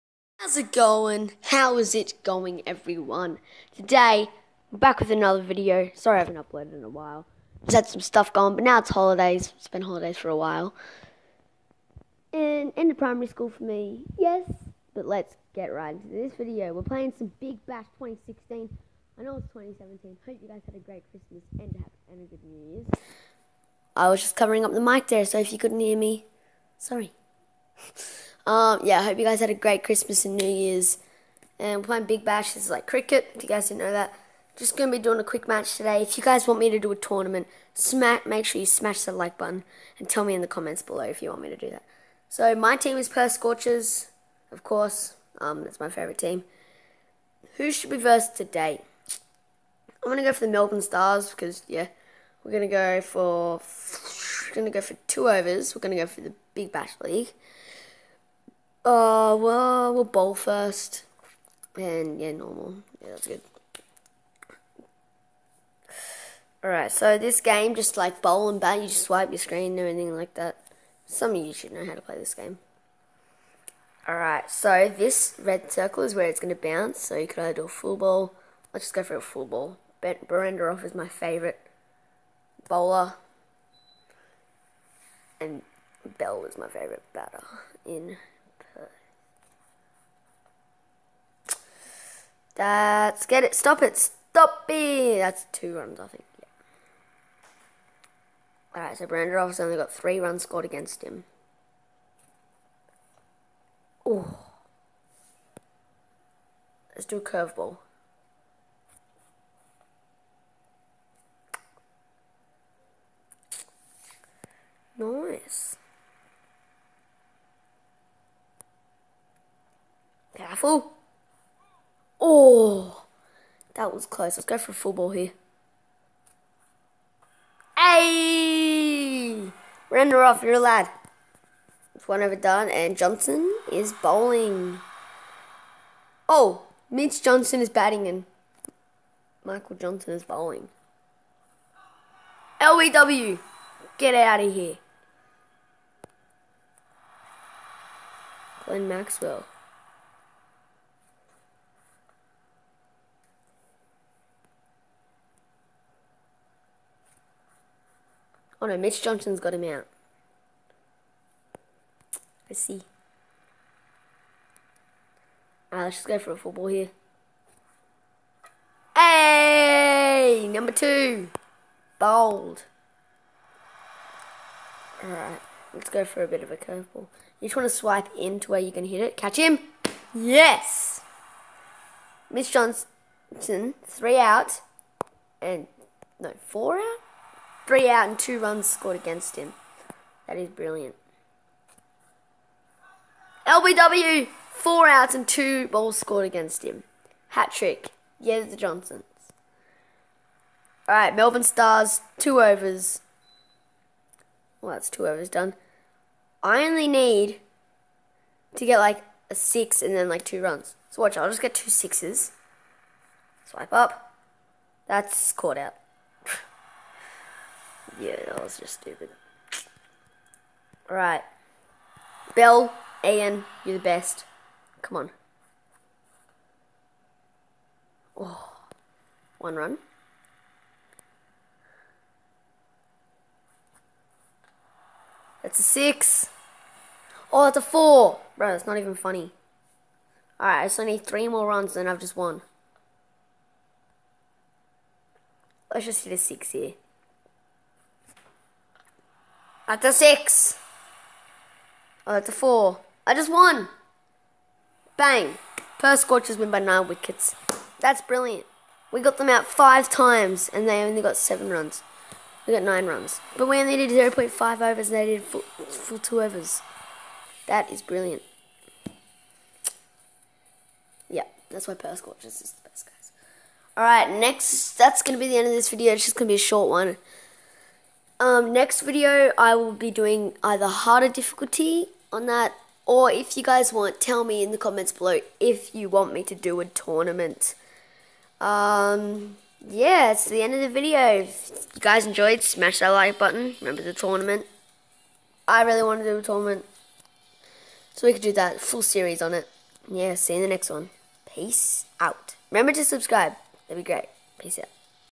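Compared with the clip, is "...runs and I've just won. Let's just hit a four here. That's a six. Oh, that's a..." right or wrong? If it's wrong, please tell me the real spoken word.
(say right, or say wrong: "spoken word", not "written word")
wrong: "six", not "four".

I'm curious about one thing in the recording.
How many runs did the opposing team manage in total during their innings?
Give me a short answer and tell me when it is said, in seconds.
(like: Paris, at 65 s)
7, at 261 s.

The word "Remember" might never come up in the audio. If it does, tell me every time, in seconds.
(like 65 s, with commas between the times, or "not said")
293 s, 302 s.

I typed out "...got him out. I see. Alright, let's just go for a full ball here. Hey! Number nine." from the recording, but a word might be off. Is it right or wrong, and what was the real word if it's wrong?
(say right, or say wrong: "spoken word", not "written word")
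wrong: "two", not "nine".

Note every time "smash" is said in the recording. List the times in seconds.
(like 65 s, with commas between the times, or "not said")
38 s, 292 s.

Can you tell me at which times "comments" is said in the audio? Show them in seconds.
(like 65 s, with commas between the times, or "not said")
40 s, 284 s.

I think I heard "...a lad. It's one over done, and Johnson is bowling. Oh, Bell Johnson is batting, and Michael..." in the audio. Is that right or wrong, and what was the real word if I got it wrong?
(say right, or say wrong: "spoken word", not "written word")
wrong: "Mitch", not "Bell".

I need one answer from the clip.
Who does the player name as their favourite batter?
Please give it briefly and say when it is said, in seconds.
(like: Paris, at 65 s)
Bell, at 86 s.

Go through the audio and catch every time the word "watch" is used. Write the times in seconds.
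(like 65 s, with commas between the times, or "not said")
211 s.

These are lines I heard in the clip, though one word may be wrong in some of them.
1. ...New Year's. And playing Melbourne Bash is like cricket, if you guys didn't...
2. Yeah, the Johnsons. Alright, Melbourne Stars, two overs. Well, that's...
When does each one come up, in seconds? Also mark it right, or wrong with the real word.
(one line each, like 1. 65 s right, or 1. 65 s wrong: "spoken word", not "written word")
1. 30 s wrong: "Big", not "Melbourne"
2. 198 s right.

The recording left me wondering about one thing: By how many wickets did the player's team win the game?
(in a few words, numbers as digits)
9.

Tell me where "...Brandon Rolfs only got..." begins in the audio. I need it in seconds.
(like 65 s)
99 s.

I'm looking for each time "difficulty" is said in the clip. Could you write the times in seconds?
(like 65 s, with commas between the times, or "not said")
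281 s.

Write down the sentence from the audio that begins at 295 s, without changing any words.
I really want to do a tournament.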